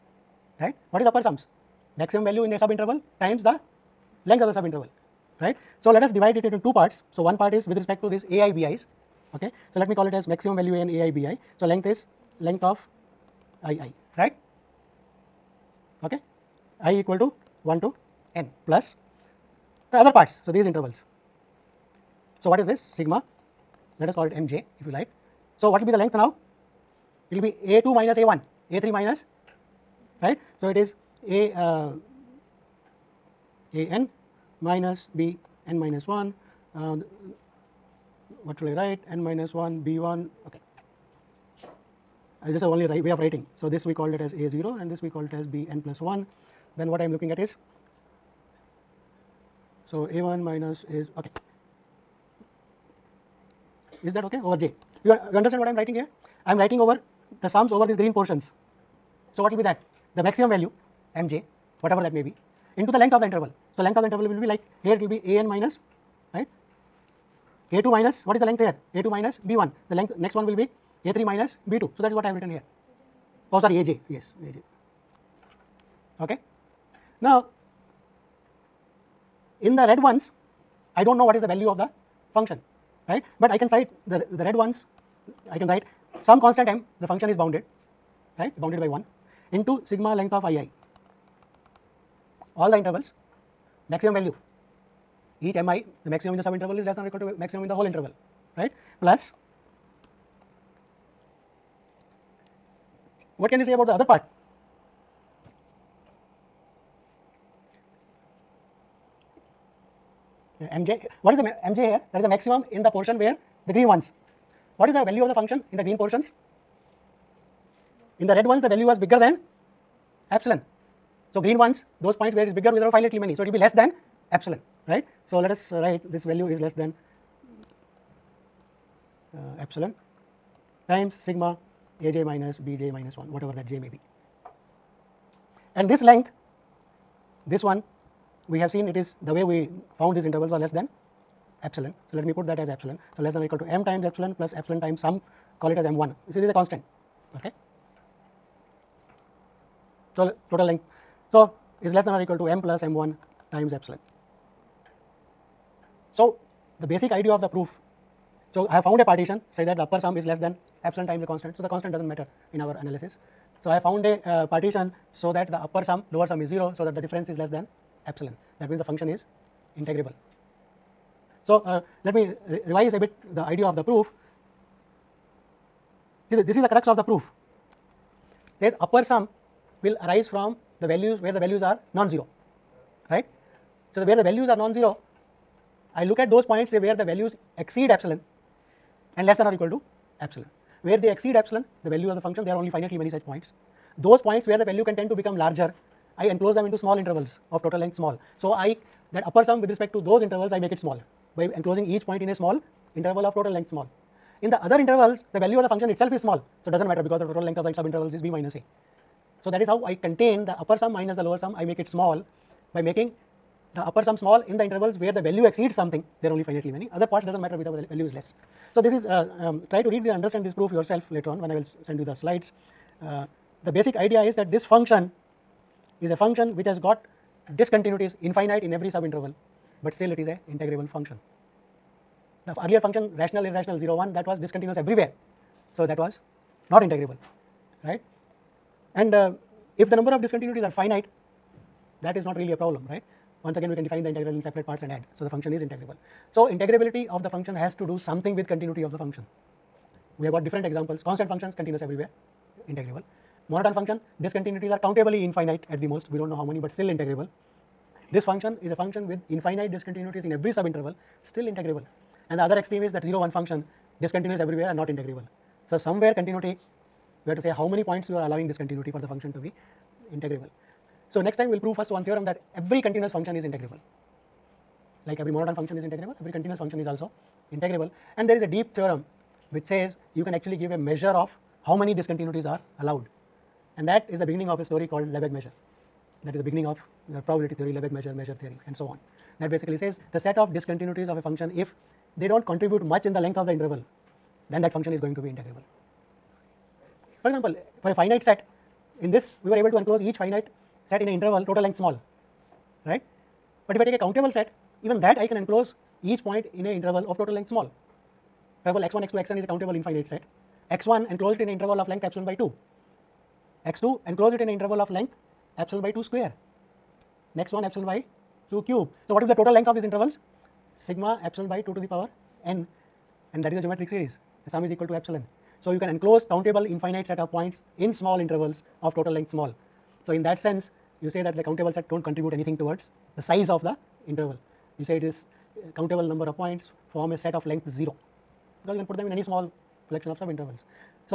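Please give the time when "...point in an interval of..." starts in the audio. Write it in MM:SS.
05:06.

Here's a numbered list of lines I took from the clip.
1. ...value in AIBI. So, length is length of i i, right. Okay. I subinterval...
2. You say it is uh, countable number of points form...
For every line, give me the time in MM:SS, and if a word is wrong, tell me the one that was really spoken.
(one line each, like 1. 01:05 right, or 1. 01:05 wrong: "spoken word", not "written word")
1. 00:10 wrong: "equal", not "subinterval"
2. 05:34 right.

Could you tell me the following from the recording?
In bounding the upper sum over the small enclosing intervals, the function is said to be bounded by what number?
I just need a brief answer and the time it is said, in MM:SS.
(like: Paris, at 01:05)
1, at 01:28.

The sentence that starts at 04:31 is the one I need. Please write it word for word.
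So, next time we will prove first one theorem that every continuous function is integrable.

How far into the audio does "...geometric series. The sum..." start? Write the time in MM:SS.
05:23.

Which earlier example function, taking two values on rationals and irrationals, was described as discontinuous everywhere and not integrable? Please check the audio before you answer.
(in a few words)
0, 1 function.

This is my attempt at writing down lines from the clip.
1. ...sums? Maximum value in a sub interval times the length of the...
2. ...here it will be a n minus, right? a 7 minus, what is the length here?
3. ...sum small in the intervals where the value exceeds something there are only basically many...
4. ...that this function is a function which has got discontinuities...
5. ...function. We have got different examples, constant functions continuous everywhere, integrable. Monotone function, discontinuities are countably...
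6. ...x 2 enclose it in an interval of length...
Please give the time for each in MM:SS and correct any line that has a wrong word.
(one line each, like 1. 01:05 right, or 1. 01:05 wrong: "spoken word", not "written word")
1. 00:01 right
2. 01:04 wrong: "2", not "7"
3. 03:34 wrong: "finitely", not "basically"
4. 03:44 right
5. 04:08 right
6. 05:13 right.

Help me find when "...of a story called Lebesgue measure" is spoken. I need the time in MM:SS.
04:44.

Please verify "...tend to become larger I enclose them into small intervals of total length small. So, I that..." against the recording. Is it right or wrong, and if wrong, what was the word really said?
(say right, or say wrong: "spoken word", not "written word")
right.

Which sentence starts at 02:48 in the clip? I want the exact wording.
That means, the function is integrable.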